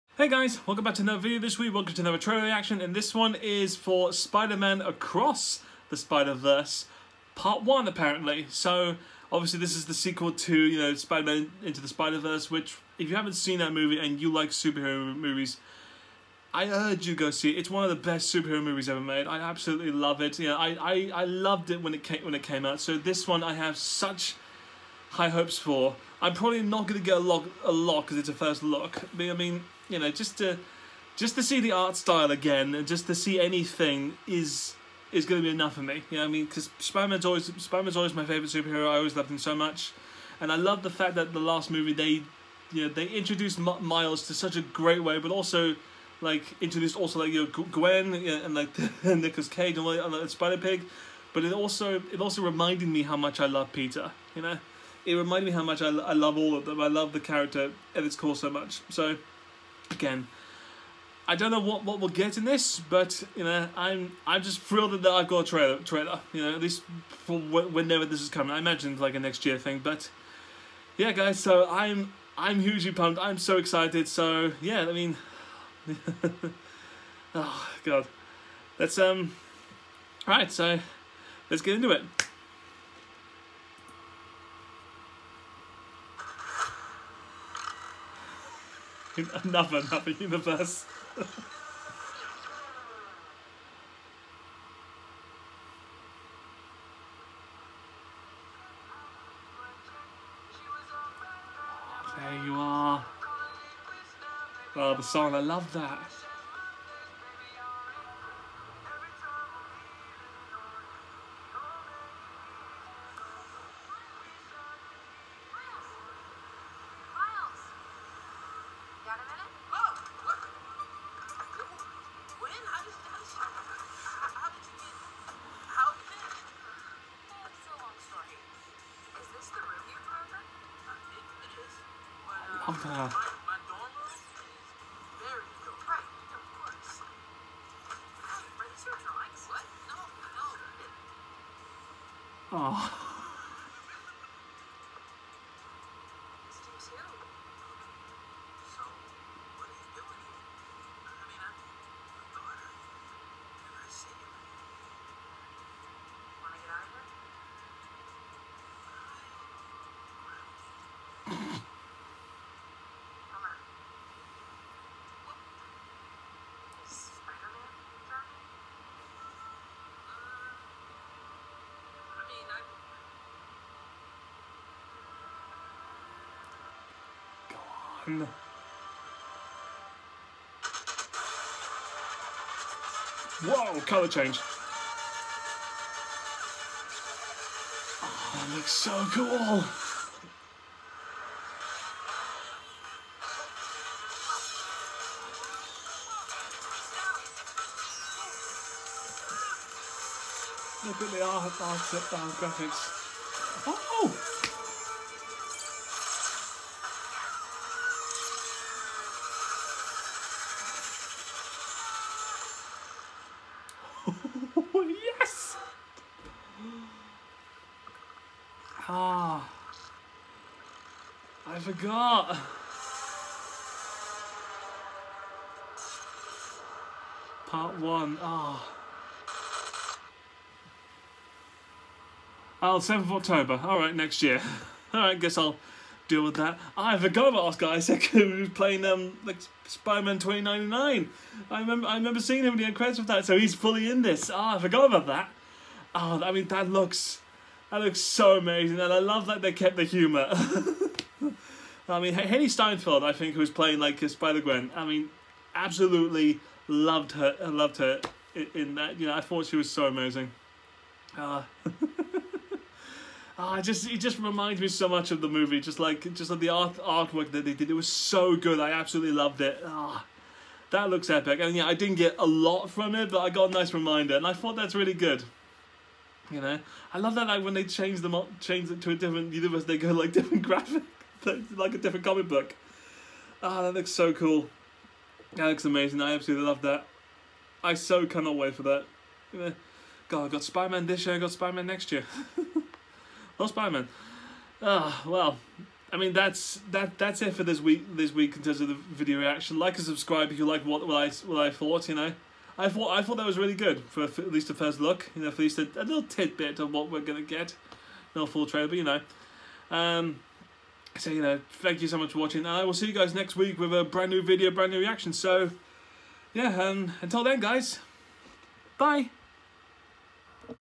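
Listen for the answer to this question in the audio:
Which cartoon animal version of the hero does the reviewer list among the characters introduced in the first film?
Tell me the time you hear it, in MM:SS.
00:50.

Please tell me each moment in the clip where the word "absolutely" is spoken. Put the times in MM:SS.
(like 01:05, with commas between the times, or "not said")
00:19, 04:15, 04:28, 04:46.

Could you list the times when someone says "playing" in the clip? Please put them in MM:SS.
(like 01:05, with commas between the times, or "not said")
03:58, 04:13.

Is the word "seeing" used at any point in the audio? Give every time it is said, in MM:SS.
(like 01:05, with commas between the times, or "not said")
04:02.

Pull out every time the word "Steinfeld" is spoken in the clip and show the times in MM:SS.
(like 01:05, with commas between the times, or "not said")
04:12.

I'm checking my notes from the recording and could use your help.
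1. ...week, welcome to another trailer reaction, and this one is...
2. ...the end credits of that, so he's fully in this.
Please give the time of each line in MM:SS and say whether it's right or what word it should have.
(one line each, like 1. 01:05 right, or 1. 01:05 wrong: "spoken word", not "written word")
1. 00:01 right
2. 04:02 right.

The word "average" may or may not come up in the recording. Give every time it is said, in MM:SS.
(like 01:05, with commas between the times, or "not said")
not said.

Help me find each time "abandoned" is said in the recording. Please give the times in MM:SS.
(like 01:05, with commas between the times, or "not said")
not said.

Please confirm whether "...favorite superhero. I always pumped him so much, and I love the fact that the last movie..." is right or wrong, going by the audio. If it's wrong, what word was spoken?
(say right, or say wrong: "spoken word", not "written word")
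wrong: "loved", not "pumped".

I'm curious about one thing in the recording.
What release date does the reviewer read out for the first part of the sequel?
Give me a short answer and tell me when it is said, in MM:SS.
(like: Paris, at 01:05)
7th of October, at 03:52.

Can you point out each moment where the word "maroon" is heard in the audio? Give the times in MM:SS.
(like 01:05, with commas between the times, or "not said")
not said.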